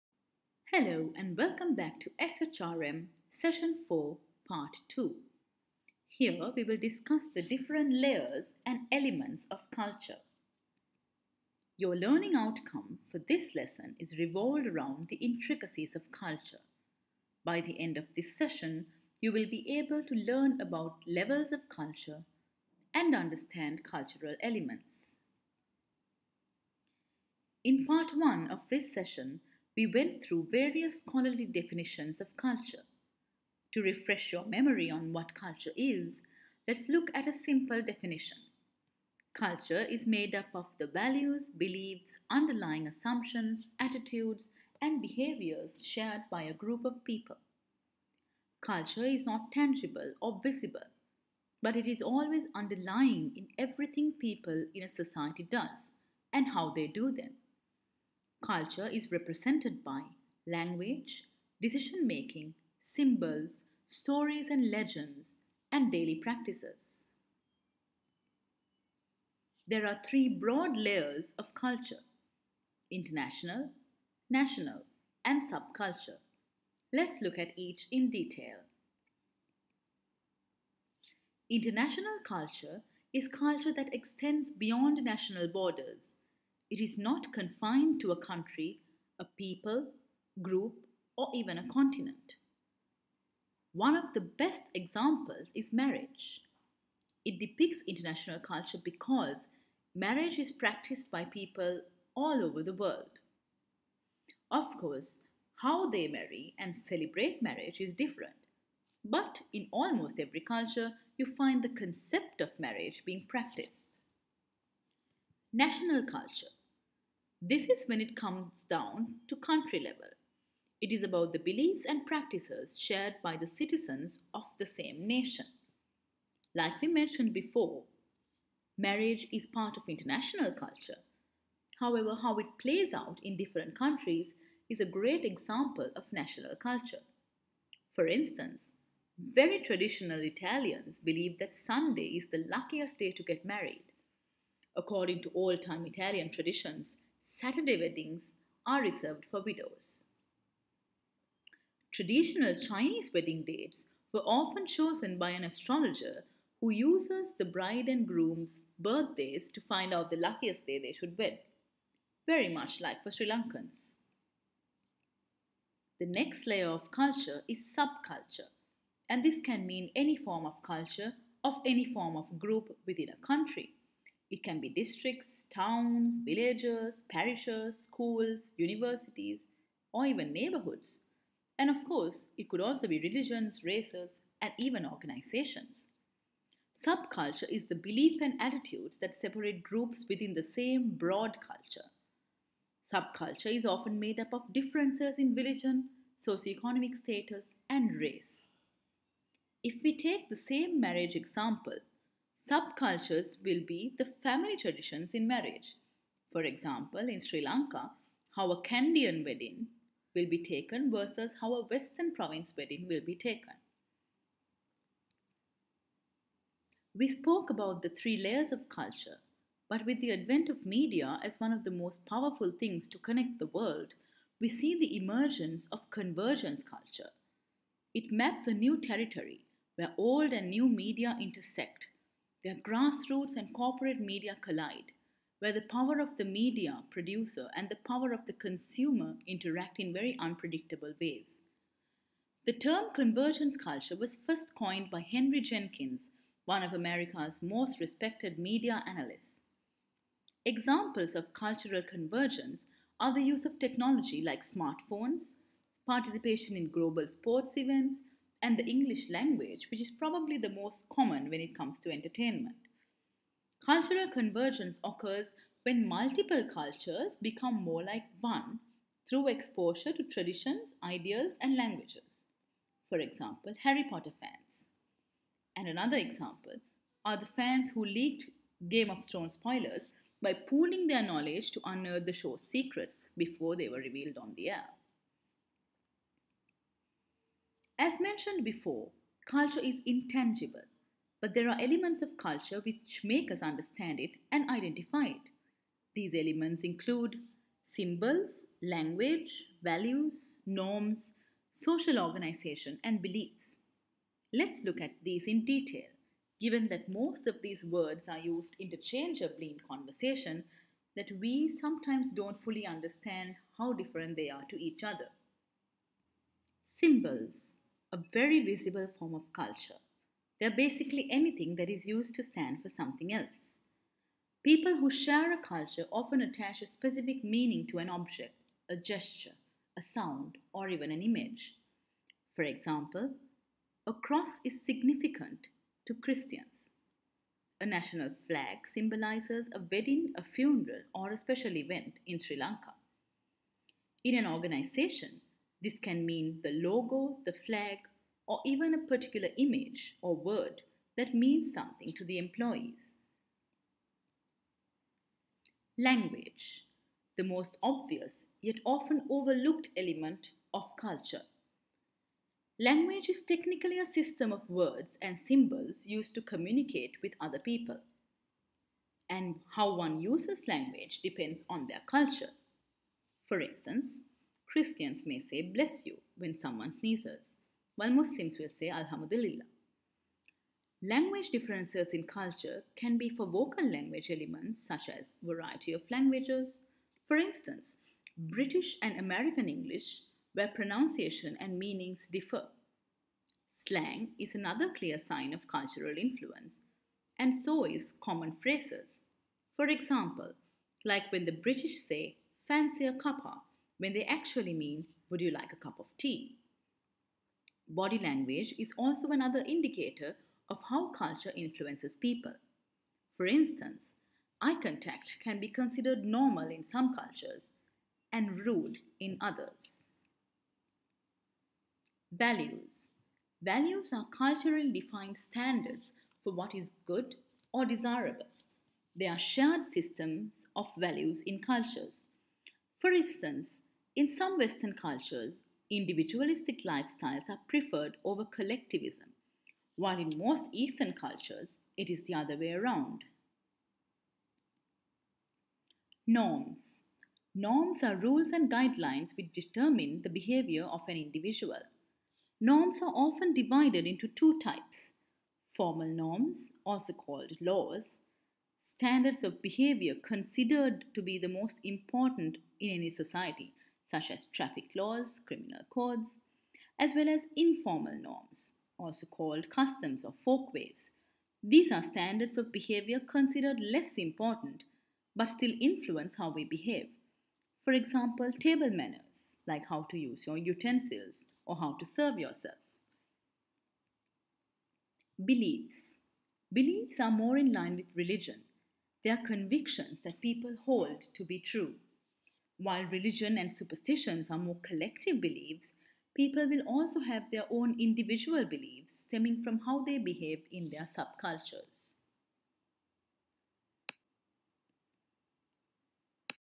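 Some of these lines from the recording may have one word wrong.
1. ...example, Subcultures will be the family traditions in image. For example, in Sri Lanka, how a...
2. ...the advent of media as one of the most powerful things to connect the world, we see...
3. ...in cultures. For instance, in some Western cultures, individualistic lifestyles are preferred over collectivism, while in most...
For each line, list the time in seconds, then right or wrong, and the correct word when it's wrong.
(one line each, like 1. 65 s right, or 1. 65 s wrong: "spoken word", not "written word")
1. 201 s wrong: "marriage", not "image"
2. 220 s right
3. 431 s right.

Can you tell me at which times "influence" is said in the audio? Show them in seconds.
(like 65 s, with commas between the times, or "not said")
395 s, 411 s, 475 s.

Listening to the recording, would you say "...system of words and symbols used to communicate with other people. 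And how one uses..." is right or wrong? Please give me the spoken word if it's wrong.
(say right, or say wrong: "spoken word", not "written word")
right.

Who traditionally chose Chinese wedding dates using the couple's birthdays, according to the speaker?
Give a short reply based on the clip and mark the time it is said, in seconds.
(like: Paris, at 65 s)
an astrologer, at 155 s.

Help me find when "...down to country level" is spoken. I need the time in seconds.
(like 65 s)
118 s.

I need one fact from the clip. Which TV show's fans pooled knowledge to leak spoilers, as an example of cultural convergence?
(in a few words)
Game of Thrones.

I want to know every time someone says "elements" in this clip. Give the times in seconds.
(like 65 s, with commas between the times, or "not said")
8 s, 24 s, 291 s, 296 s, 359 s, 384 s.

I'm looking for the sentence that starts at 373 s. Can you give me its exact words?
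For instance, Christians may say, bless you, when someone sneezes, while Muslims will say, Alhamdulillah.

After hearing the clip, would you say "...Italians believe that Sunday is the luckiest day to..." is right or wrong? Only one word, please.
right.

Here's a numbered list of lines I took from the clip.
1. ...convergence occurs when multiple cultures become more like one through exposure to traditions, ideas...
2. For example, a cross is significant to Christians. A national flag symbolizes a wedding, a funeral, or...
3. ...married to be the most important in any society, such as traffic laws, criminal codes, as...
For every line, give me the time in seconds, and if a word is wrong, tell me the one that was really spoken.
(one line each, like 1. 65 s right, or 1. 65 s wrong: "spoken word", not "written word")
1. 264 s right
2. 332 s right
3. 460 s wrong: "considered", not "married".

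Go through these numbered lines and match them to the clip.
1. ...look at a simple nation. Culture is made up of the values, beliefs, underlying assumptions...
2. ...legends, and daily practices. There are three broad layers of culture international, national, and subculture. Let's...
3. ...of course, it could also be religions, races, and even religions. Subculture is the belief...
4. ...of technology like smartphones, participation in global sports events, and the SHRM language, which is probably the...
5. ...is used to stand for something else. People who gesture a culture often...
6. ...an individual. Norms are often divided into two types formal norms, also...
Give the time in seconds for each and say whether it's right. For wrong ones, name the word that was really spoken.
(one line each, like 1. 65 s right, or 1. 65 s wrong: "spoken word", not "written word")
1. 36 s wrong: "definition", not "nation"
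2. 64 s right
3. 181 s wrong: "organizations", not "religions"
4. 253 s wrong: "English", not "SHRM"
5. 321 s wrong: "share", not "gesture"
6. 450 s right.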